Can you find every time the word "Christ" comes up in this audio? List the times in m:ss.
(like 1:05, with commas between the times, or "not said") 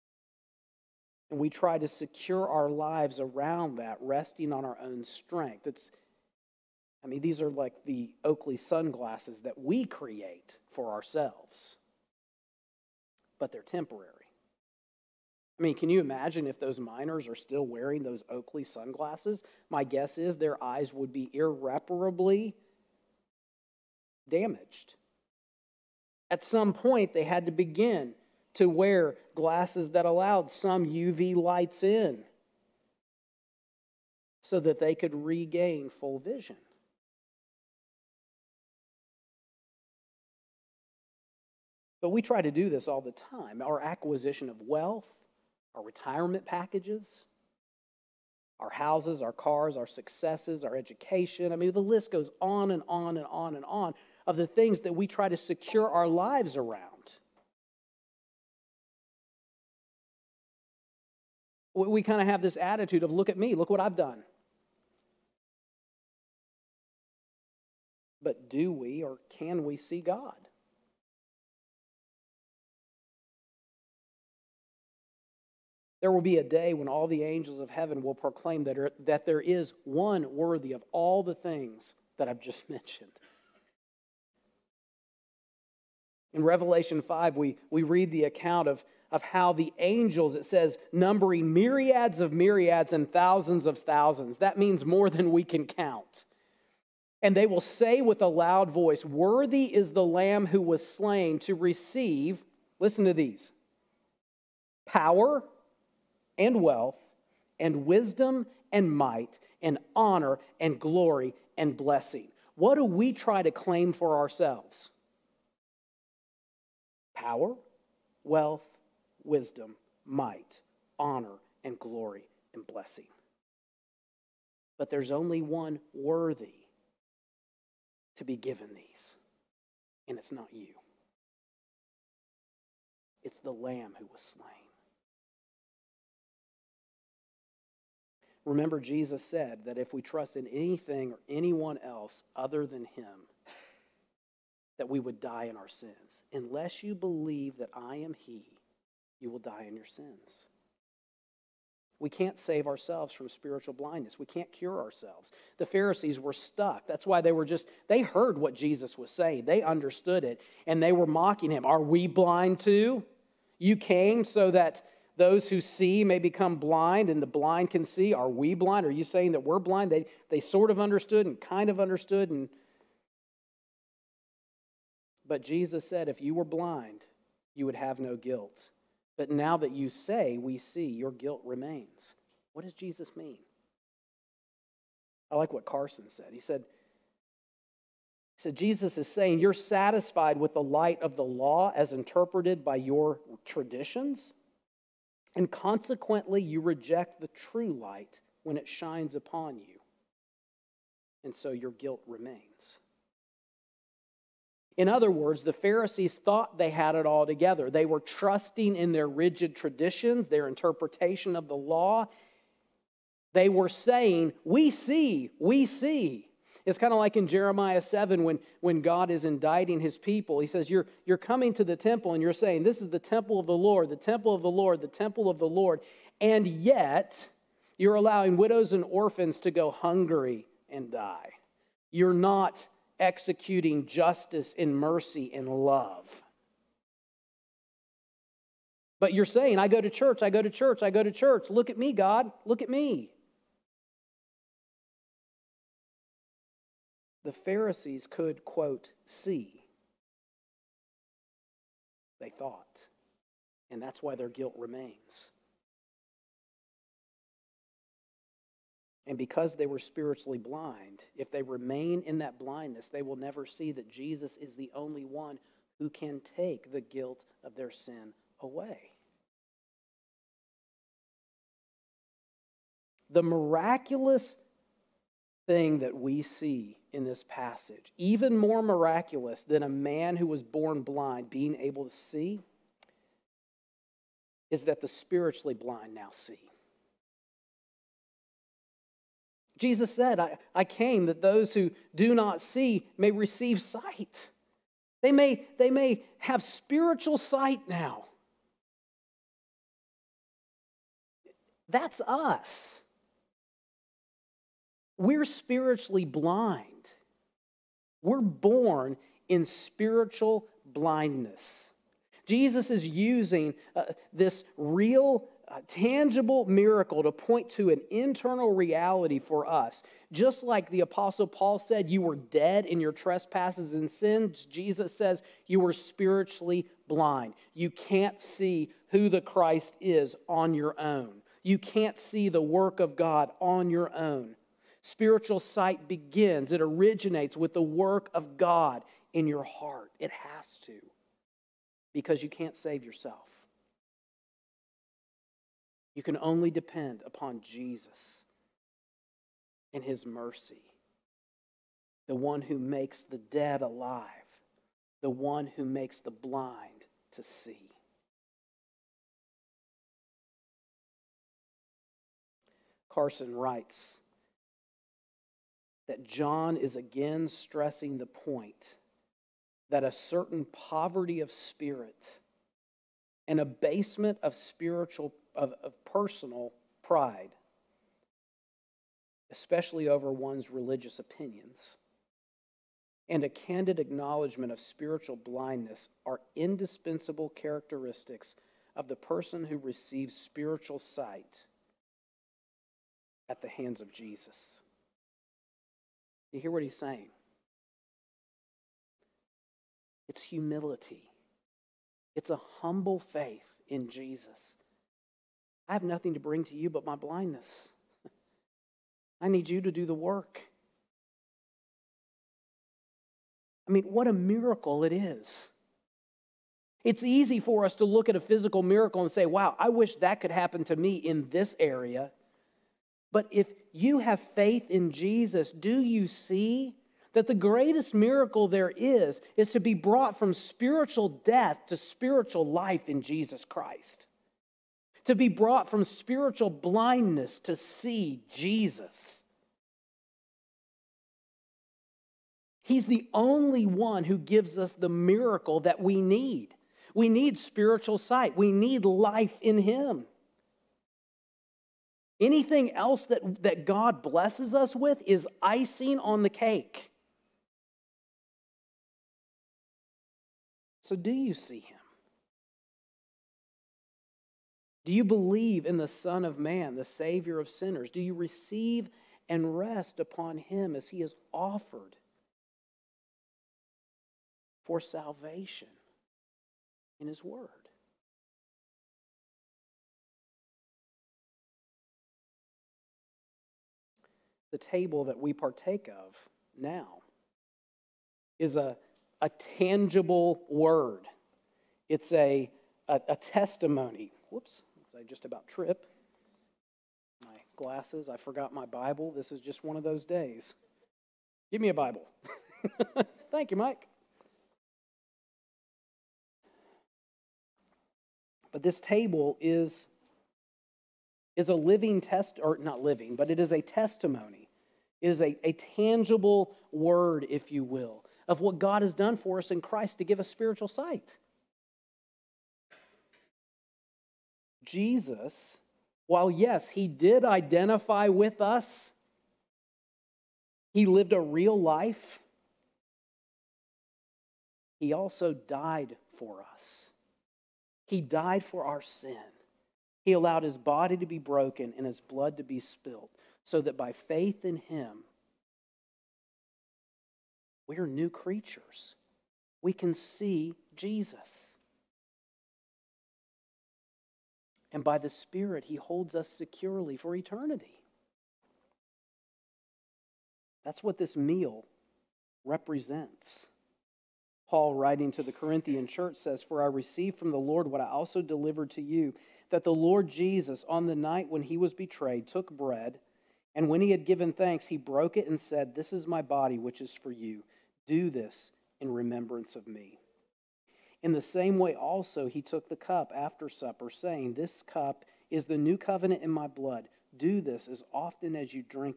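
5:29, 7:13, 8:39.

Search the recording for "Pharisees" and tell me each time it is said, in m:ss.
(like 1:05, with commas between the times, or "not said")
2:35, 3:25, 4:07.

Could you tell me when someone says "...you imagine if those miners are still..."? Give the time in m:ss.
0:15.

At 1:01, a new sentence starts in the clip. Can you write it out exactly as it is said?
We kind of have this attitude of, look at me, look what I've done.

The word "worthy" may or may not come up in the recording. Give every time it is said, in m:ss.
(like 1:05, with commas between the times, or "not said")
1:20, 1:39, 2:05.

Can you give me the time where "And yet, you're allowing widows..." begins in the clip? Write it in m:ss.
3:46.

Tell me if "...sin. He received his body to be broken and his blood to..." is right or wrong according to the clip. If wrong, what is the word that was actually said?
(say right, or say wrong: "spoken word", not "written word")
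wrong: "allowed", not "received".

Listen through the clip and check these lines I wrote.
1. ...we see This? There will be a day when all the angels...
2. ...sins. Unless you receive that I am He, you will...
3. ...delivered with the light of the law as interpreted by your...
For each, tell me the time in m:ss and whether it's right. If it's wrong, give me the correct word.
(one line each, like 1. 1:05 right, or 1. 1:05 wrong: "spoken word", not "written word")
1. 1:09 wrong: "God", not "This"
2. 2:25 wrong: "believe", not "receive"
3. 3:09 wrong: "satisfied", not "delivered".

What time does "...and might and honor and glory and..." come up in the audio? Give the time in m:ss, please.
1:48.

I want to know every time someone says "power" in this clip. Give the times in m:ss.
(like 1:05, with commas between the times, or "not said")
1:44, 1:57.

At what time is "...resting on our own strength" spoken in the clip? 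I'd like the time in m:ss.
0:04.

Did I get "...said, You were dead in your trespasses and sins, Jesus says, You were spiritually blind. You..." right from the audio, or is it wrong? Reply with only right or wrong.
right.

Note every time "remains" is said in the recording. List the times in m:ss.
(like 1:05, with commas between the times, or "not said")
3:01, 3:22, 4:14, 4:21.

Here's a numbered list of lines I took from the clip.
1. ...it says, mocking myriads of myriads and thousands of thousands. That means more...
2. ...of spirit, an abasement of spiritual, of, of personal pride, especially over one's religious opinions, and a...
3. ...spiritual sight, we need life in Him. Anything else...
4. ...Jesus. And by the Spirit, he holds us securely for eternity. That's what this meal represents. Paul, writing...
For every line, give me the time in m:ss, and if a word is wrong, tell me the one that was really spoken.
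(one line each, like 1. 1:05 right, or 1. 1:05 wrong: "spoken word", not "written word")
1. 1:30 wrong: "numbering", not "mocking"
2. 6:11 right
3. 7:27 right
4. 9:10 right.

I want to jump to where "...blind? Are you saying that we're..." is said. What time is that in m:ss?
2:48.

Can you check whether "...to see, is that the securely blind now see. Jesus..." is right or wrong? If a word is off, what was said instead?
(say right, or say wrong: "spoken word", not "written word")
wrong: "spiritually", not "securely".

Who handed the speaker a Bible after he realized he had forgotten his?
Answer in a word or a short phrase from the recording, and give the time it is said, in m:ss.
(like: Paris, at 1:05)
Mike, at 8:23.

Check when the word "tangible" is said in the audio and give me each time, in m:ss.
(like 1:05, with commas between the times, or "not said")
5:15, 8:09, 8:35.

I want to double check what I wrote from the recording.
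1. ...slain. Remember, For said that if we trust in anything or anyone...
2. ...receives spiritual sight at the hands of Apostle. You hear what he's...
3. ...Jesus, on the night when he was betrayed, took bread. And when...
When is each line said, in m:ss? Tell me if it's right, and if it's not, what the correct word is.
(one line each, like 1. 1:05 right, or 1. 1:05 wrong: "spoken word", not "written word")
1. 2:14 wrong: "Jesus", not "For"
2. 6:29 wrong: "Jesus", not "Apostle"
3. 9:30 right.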